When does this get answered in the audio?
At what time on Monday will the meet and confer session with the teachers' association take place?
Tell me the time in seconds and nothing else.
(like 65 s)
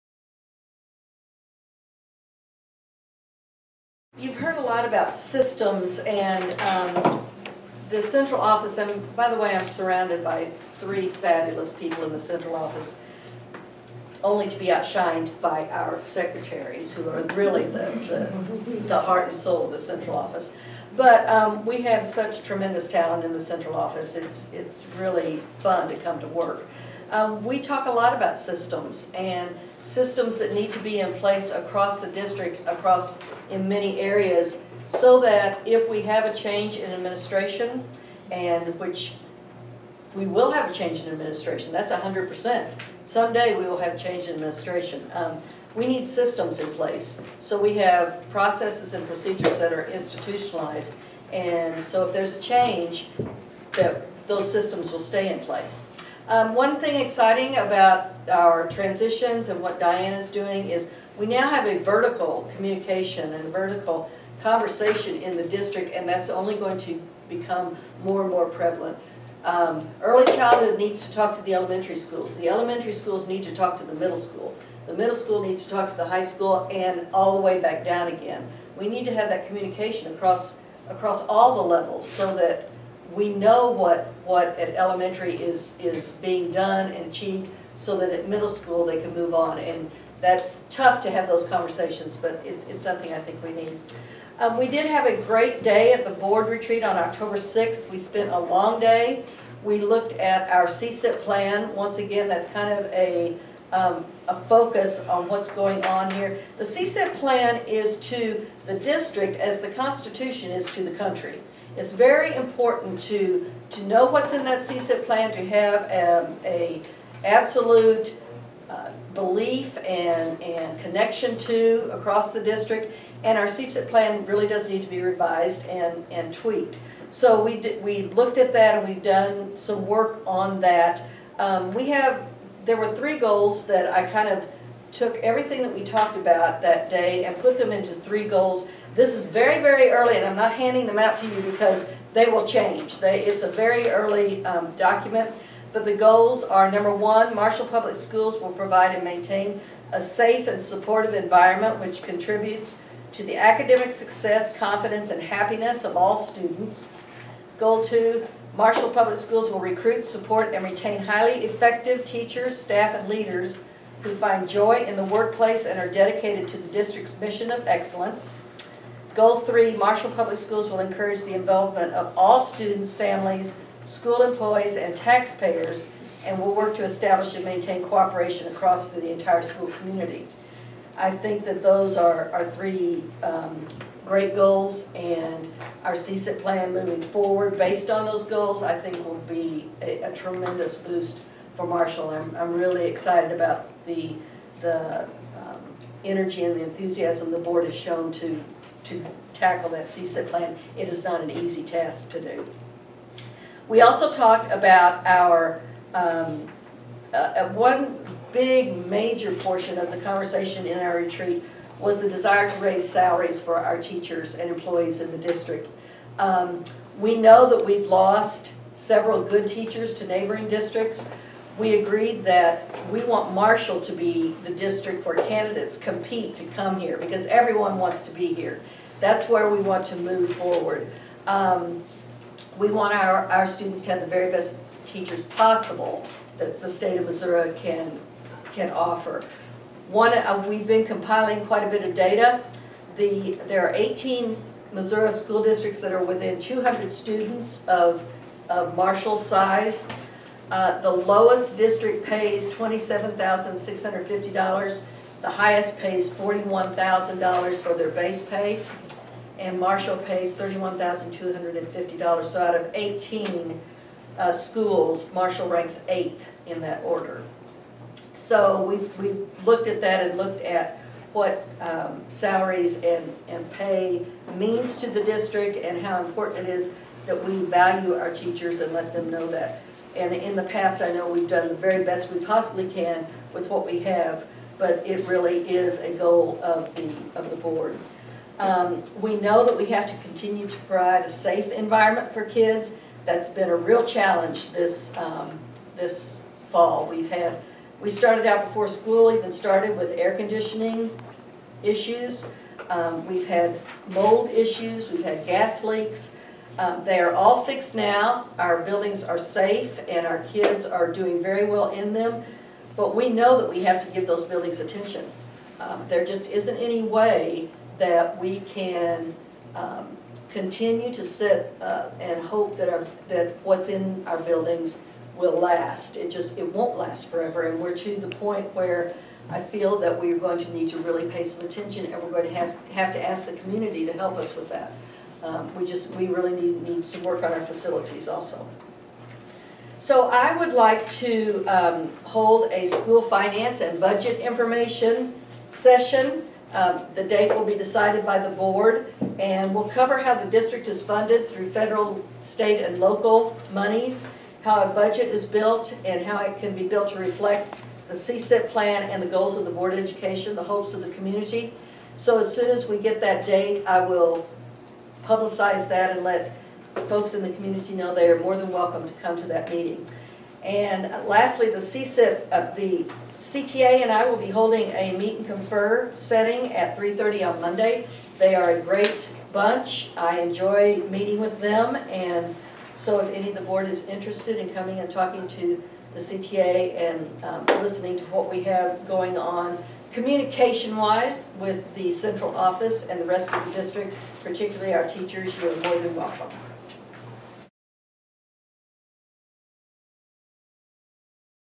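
376 s.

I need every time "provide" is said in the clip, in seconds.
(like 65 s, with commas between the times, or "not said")
148 s, 290 s.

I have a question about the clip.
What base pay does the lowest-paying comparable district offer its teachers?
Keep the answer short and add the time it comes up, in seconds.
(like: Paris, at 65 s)
$27,650, at 252 s.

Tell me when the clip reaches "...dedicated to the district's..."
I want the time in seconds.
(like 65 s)
165 s.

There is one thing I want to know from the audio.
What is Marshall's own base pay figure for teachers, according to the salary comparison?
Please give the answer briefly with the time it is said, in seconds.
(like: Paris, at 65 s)
$31,250, at 260 s.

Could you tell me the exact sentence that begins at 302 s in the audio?
Um, we've had mold issues, we've had gas leaks, um, they are all fixed now.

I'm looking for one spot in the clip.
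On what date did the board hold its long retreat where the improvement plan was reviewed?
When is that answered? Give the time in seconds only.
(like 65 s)
96 s.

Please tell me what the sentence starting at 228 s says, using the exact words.
That's where we want to move forward.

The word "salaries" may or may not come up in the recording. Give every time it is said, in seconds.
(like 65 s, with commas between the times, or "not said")
212 s, 272 s.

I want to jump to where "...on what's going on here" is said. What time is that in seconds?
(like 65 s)
105 s.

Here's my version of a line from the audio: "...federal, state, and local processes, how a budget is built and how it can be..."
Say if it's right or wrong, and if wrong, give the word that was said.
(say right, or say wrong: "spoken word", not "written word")
wrong: "monies", not "processes".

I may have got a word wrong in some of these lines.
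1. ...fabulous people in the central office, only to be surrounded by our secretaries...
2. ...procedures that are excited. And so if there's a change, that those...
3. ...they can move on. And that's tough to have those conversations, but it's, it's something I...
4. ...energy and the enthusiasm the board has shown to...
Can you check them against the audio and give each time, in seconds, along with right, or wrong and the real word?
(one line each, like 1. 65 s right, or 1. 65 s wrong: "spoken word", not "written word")
1. 11 s wrong: "outshined", not "surrounded"
2. 49 s wrong: "institutionalized", not "excited"
3. 88 s right
4. 196 s right.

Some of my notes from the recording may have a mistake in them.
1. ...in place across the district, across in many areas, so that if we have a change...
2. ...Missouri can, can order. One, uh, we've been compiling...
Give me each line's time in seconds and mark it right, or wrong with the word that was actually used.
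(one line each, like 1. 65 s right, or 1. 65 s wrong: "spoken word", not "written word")
1. 31 s right
2. 237 s wrong: "offer", not "order".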